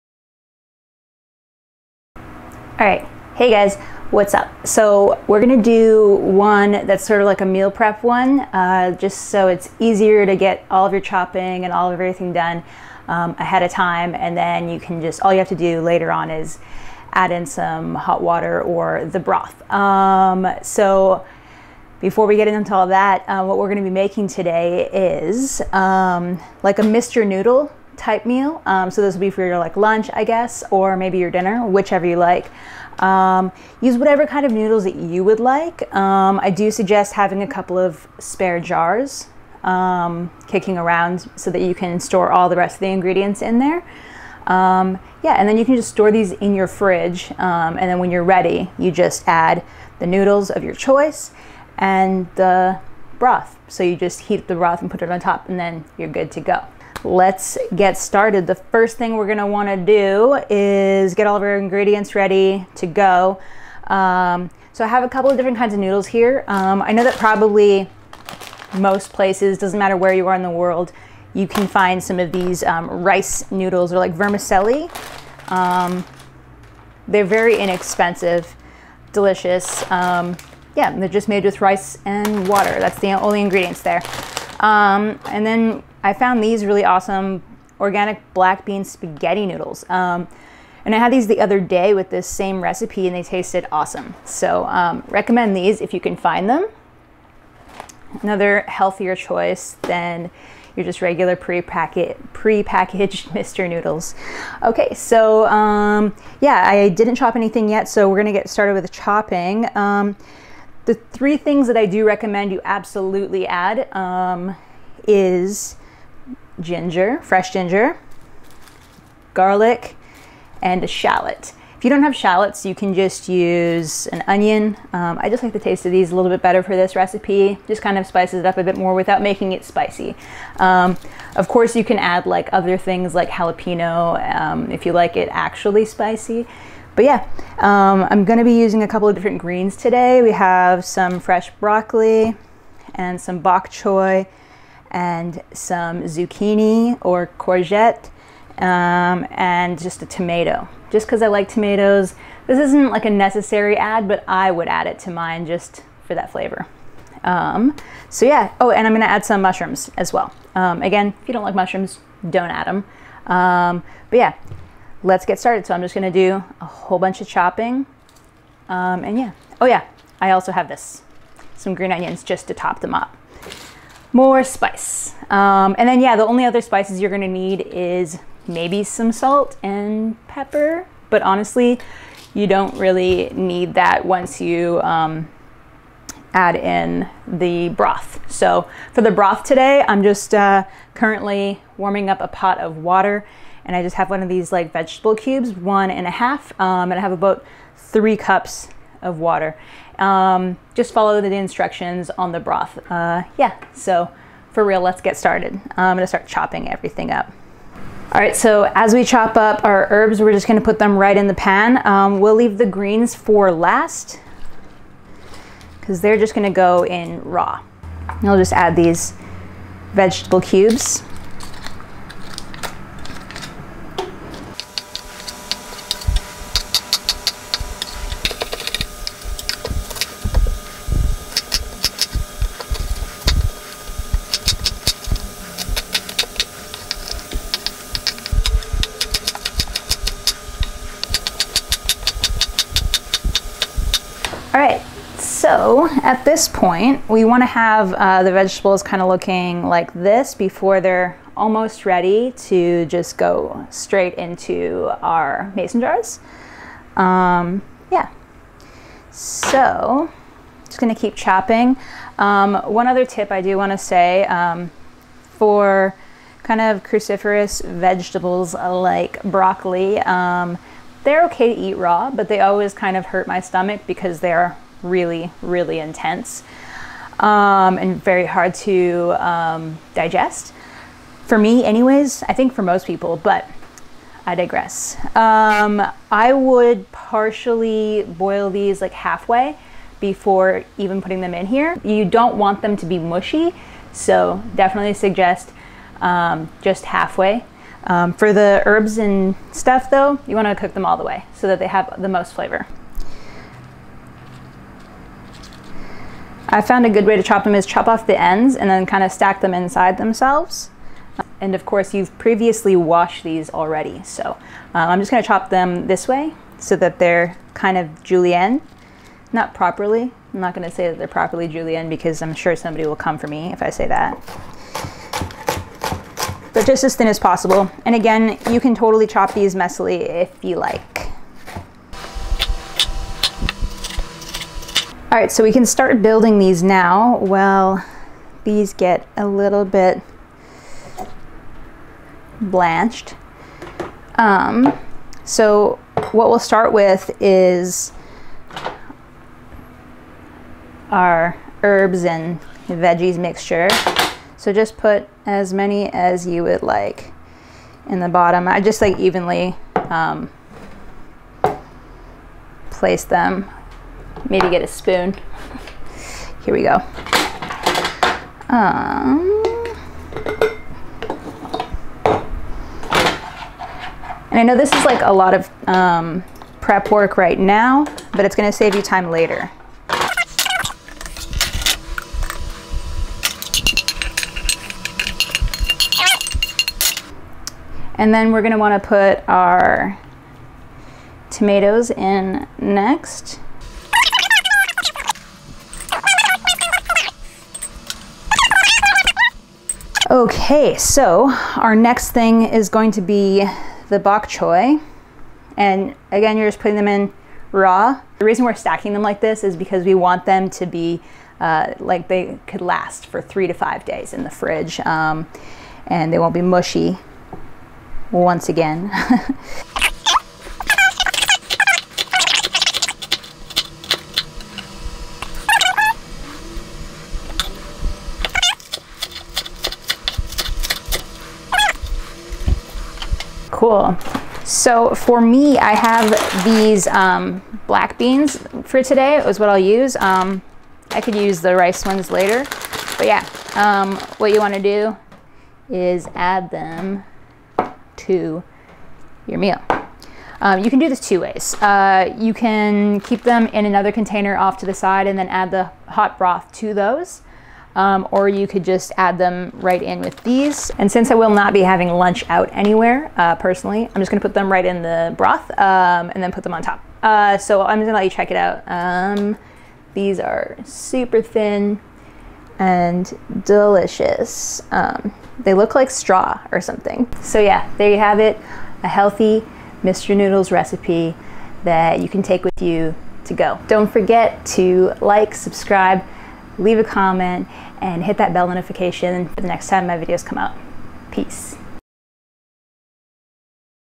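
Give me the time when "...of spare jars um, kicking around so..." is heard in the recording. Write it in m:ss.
0:37.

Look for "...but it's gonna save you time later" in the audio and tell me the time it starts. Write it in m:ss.
6:18.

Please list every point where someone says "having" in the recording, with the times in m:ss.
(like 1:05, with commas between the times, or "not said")
0:37, 7:41.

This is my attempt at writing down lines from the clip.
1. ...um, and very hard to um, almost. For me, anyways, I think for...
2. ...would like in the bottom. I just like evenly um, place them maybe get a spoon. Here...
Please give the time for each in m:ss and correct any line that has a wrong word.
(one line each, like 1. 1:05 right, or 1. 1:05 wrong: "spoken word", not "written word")
1. 4:37 wrong: "digest", not "almost"
2. 5:56 right.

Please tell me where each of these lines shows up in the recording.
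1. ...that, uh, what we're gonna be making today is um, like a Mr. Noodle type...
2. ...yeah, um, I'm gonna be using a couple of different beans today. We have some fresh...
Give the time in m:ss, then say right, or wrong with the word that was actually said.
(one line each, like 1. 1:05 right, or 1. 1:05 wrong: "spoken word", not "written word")
1. 0:22 right
2. 2:17 wrong: "greens", not "beans".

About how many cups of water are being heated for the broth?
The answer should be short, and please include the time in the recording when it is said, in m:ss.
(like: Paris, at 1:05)
3, at 3:17.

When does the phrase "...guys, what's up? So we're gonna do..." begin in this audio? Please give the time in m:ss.
0:03.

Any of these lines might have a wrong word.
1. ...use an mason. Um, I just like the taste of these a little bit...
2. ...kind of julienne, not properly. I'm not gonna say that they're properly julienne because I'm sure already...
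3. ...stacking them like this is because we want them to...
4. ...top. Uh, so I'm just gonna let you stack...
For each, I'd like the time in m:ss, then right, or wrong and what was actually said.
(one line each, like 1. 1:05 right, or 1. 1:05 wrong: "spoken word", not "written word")
1. 2:03 wrong: "onion", not "mason"
2. 5:17 wrong: "somebody", not "already"
3. 6:48 right
4. 7:46 wrong: "check", not "stack".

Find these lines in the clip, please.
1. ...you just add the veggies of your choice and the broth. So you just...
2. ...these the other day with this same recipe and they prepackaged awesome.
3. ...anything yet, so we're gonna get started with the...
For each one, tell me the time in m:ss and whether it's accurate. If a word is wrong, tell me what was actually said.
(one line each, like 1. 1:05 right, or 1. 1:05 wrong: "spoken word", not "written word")
1. 0:48 wrong: "noodles", not "veggies"
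2. 1:31 wrong: "tasted", not "prepackaged"
3. 1:47 right.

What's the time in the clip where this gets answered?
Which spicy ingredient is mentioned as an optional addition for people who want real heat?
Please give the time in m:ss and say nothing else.
2:13.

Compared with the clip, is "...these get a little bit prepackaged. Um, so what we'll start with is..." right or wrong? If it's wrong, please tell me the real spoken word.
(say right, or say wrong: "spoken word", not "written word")
wrong: "blanched", not "prepackaged".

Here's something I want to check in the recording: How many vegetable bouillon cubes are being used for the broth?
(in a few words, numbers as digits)
One and a half.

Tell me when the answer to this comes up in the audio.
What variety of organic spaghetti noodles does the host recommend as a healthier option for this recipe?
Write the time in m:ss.
1:27.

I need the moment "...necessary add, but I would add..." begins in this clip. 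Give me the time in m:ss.
2:33.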